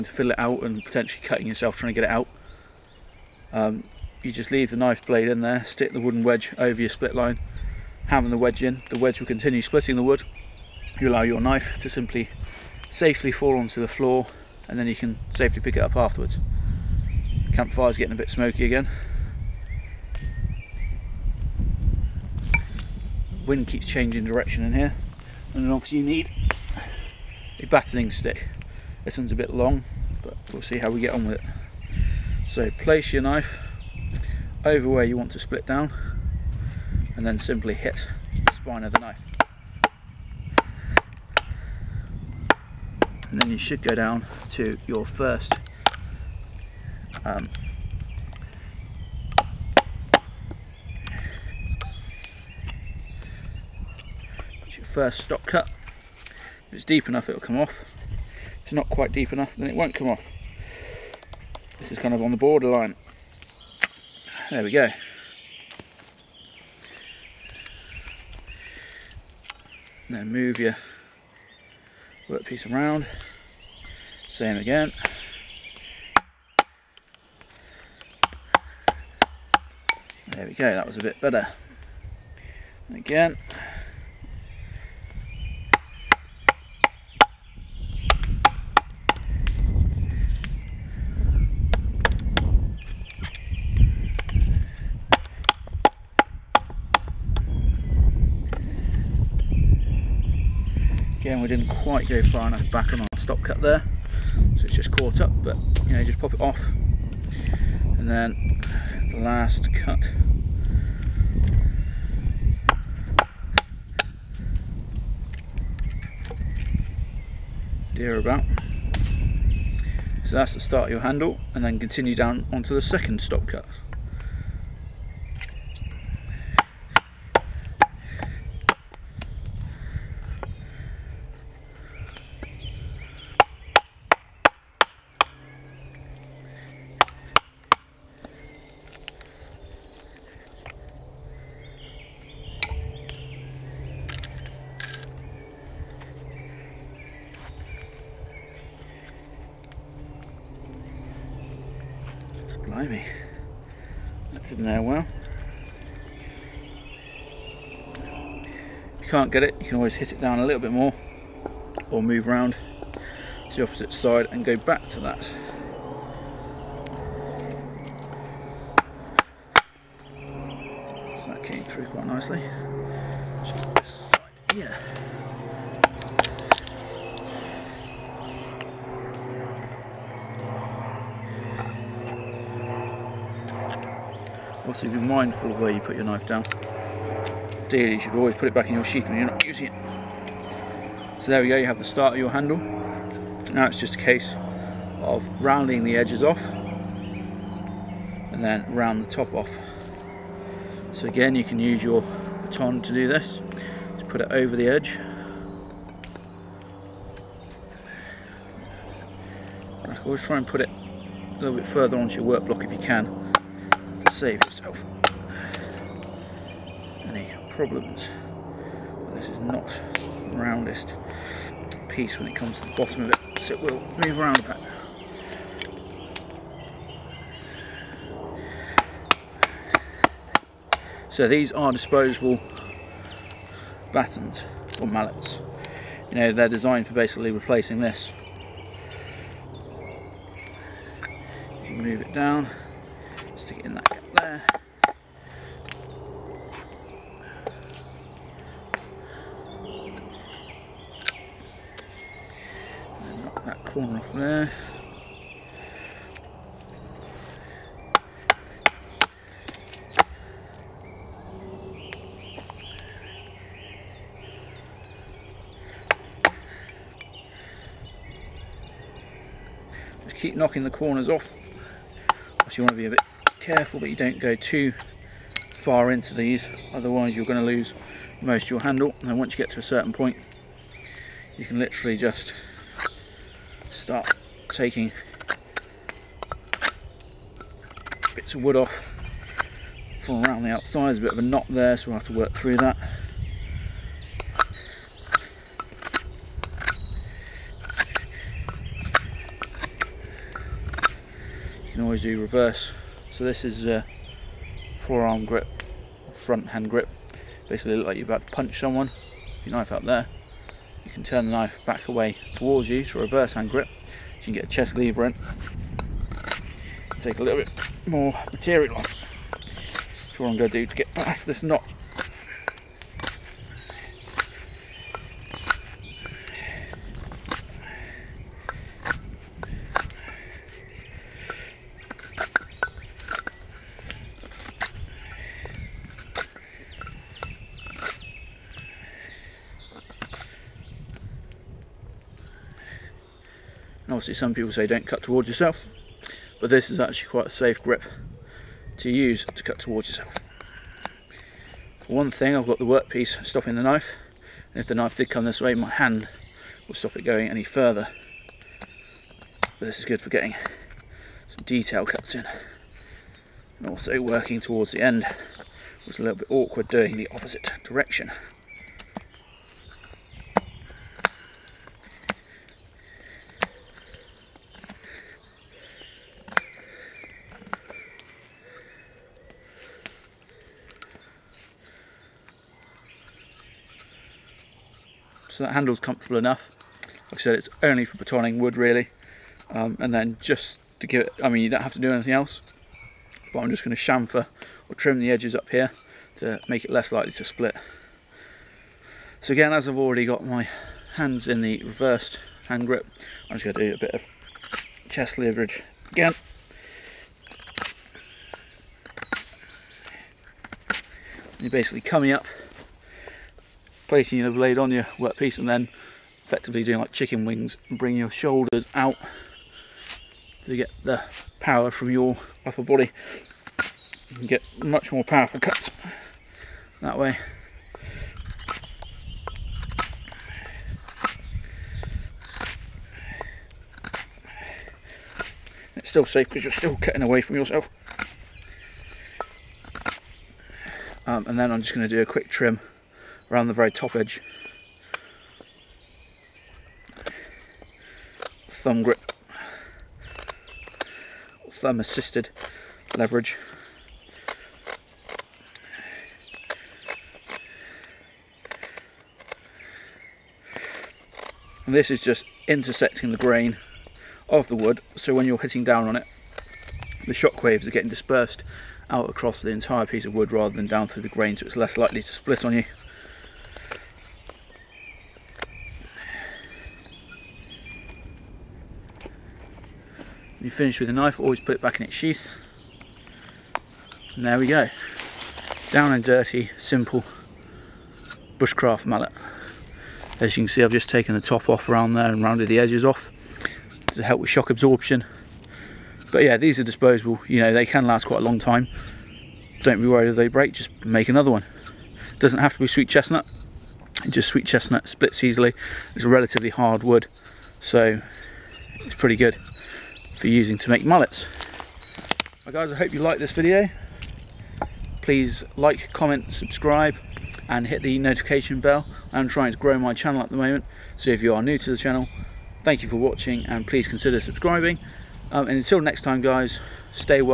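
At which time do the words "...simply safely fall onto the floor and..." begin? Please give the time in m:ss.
0:11.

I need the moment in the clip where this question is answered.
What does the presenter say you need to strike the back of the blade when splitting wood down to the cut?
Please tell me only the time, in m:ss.
0:27.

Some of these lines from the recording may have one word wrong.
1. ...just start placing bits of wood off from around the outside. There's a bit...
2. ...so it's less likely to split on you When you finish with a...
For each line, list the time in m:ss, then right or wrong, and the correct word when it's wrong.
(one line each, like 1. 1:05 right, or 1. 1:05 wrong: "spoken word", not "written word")
1. 4:41 wrong: "taking", not "placing"
2. 7:51 right.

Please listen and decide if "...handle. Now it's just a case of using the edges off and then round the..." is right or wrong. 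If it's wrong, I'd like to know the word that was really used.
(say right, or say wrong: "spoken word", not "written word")
wrong: "rounding", not "using".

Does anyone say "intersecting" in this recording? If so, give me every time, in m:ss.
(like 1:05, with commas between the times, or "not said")
7:42.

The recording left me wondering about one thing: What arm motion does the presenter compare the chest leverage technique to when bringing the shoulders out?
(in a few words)
chicken wings.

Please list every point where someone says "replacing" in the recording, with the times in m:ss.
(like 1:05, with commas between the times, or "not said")
3:57.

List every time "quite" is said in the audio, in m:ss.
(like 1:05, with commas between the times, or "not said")
0:58, 1:41, 2:51, 5:47, 8:18.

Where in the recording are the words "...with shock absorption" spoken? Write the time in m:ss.
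8:14.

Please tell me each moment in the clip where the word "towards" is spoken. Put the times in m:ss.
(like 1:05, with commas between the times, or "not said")
5:12, 5:45, 5:49, 6:04.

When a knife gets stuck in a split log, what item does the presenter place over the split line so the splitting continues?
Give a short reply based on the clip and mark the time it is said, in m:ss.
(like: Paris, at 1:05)
wooden wedge, at 0:05.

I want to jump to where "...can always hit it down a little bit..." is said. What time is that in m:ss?
2:39.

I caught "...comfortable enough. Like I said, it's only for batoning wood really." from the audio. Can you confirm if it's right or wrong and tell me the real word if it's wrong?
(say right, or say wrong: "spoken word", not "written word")
right.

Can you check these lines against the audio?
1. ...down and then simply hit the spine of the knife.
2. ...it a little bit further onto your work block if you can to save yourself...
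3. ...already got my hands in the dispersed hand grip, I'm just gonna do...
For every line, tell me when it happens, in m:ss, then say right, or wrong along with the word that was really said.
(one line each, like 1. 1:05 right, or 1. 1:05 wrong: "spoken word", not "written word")
1. 0:35 right
2. 3:30 right
3. 6:39 wrong: "reversed", not "dispersed".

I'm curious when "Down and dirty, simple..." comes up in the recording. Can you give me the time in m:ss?
8:05.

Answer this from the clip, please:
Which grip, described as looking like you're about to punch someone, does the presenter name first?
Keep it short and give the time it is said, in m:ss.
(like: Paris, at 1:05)
forearm grip, at 5:04.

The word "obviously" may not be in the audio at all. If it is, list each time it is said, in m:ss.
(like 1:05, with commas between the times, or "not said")
0:25, 4:32, 5:43.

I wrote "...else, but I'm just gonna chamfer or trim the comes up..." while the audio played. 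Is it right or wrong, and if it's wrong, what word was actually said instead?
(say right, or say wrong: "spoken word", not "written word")
wrong: "edges", not "comes".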